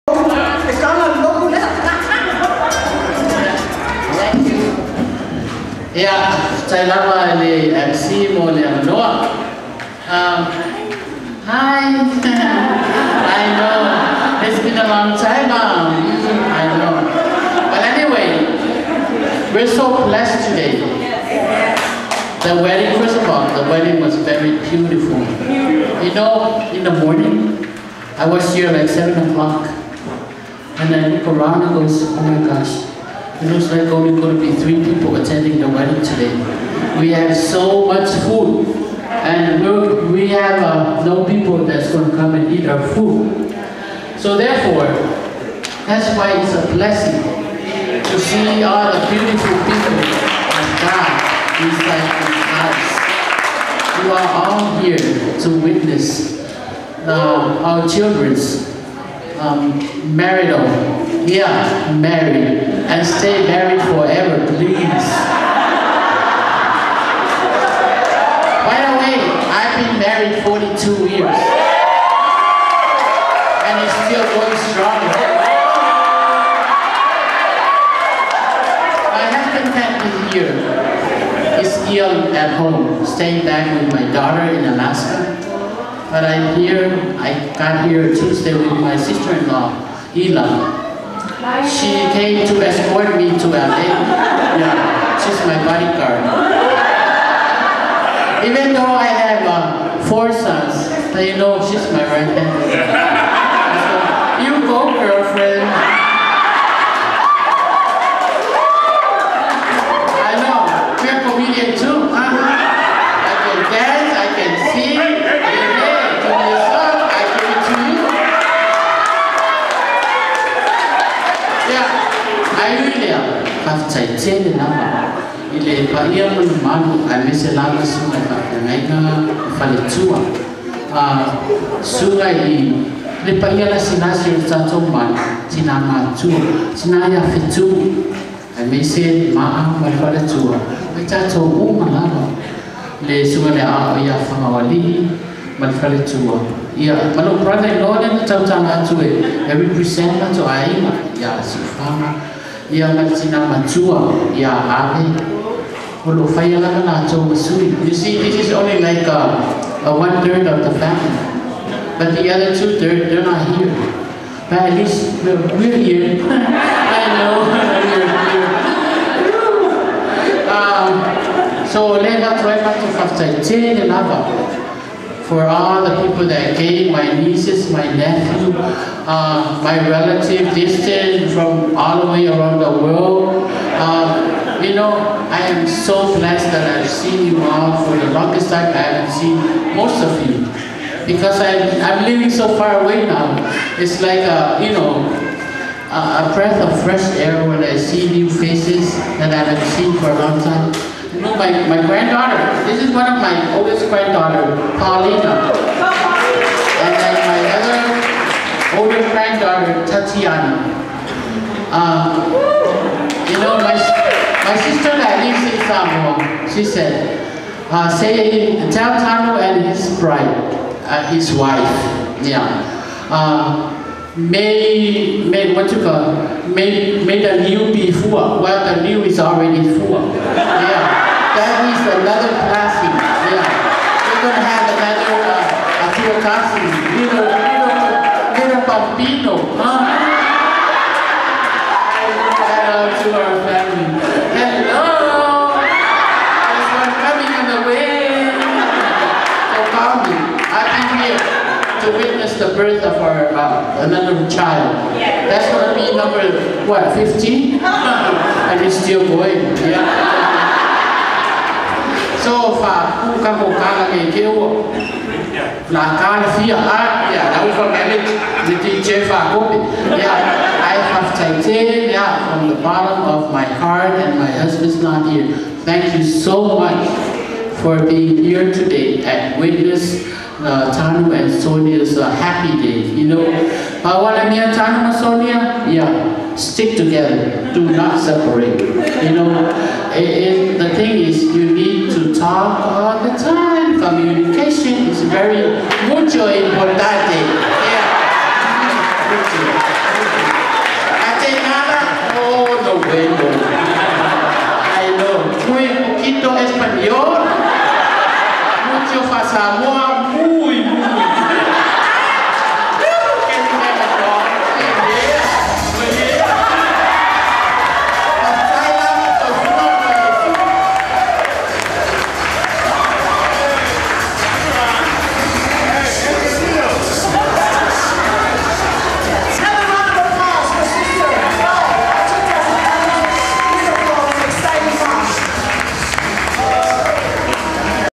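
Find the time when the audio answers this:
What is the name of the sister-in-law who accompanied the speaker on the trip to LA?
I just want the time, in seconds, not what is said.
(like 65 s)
90 s.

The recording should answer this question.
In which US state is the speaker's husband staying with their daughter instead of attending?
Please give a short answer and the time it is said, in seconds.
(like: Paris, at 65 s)
Alaska, at 84 s.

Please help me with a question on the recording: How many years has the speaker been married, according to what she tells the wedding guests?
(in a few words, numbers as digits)
42.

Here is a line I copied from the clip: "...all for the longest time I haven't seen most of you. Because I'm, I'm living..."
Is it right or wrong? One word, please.
right.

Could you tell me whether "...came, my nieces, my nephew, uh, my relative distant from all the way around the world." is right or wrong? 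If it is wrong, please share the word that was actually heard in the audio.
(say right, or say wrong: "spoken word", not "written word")
right.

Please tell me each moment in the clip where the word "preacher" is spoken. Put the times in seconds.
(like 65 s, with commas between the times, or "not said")
not said.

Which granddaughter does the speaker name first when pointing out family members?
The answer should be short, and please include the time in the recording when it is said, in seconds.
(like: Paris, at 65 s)
Paulina, at 204 s.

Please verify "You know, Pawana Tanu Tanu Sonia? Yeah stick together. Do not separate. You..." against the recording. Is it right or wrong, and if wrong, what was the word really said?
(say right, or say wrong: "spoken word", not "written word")
wrong: "Mia", not "Tanu".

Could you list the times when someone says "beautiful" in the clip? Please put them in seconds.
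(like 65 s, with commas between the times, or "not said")
24 s, 49 s.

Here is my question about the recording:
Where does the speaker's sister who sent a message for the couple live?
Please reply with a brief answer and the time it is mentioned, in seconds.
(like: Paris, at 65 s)
Samoa, at 215 s.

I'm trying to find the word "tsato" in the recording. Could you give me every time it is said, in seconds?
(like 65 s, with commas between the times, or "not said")
134 s, 141 s.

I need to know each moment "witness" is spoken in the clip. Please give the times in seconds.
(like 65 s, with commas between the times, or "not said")
55 s, 251 s, 279 s.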